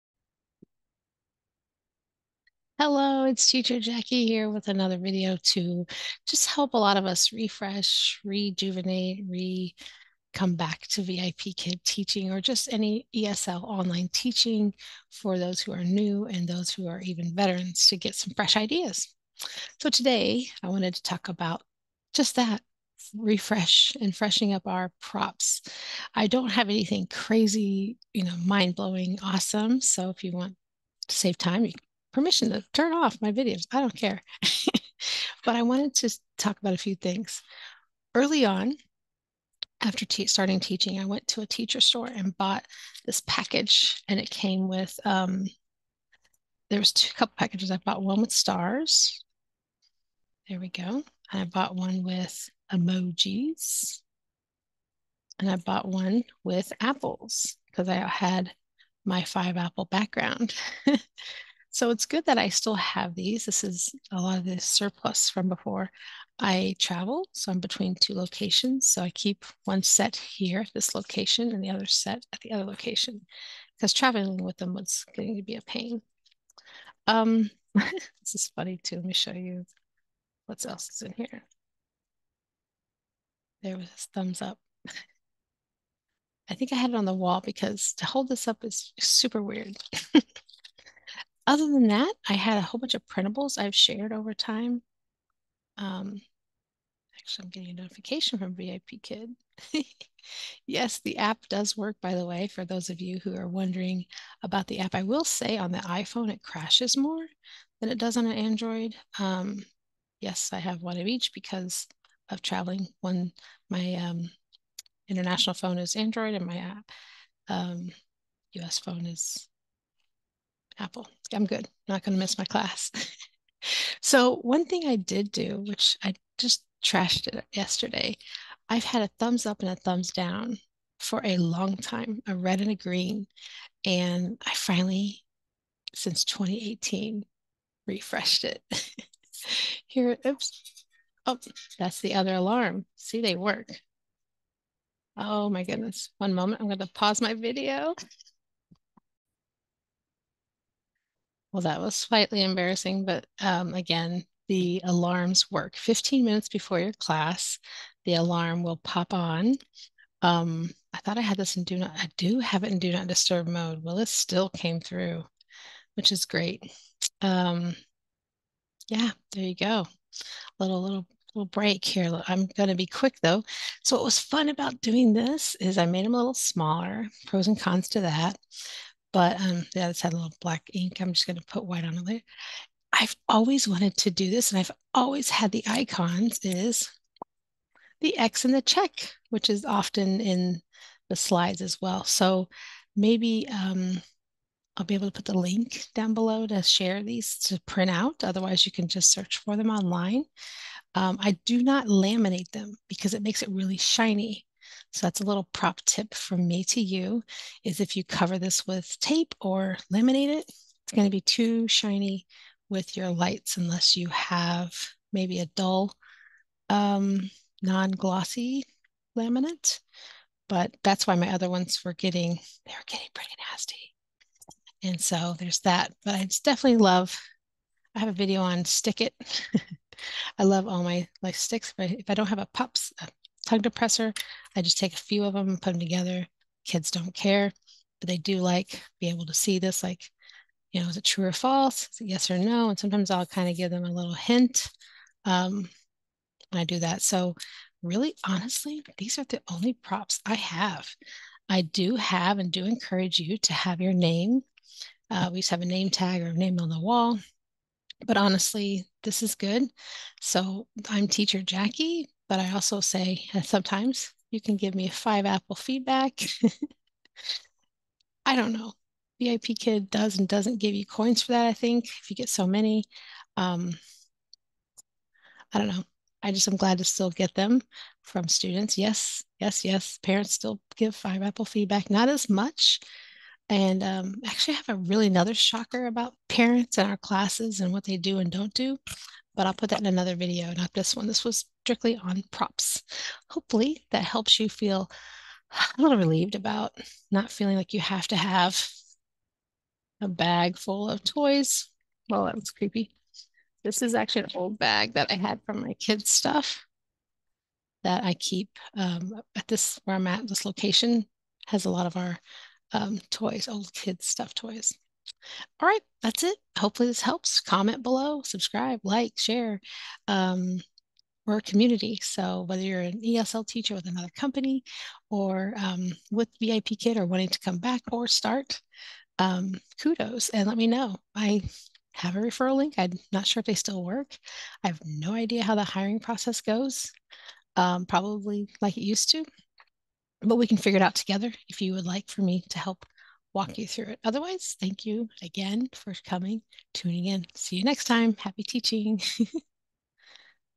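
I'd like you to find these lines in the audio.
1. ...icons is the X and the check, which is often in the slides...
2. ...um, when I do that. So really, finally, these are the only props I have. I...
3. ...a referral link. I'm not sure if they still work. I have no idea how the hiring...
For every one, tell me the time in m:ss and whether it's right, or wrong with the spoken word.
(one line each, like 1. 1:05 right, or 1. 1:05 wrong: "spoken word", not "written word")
1. 3:05 right
2. 4:05 wrong: "honestly", not "finally"
3. 5:32 right.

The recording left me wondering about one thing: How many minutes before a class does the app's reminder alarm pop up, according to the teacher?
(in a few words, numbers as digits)
15.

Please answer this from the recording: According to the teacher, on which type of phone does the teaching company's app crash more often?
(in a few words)
iPhone.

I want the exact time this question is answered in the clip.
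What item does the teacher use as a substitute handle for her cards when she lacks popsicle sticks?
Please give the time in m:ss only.
3:52.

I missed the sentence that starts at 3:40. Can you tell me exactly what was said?
But that's why my other ones were getting, they were getting pretty nasty.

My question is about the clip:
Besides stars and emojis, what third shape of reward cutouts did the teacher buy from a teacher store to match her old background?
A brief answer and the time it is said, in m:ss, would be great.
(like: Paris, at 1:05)
Apples, at 0:55.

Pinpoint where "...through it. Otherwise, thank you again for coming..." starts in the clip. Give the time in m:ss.
5:43.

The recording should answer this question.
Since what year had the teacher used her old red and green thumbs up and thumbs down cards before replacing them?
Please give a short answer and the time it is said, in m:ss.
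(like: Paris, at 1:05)
2018, at 2:15.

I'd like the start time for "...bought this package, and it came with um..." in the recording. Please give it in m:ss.
0:42.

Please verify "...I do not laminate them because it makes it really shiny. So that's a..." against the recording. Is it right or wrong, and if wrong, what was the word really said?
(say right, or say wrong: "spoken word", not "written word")
right.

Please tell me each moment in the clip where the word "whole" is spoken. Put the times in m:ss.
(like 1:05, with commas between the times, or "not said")
1:32.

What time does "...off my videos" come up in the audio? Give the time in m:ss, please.
0:32.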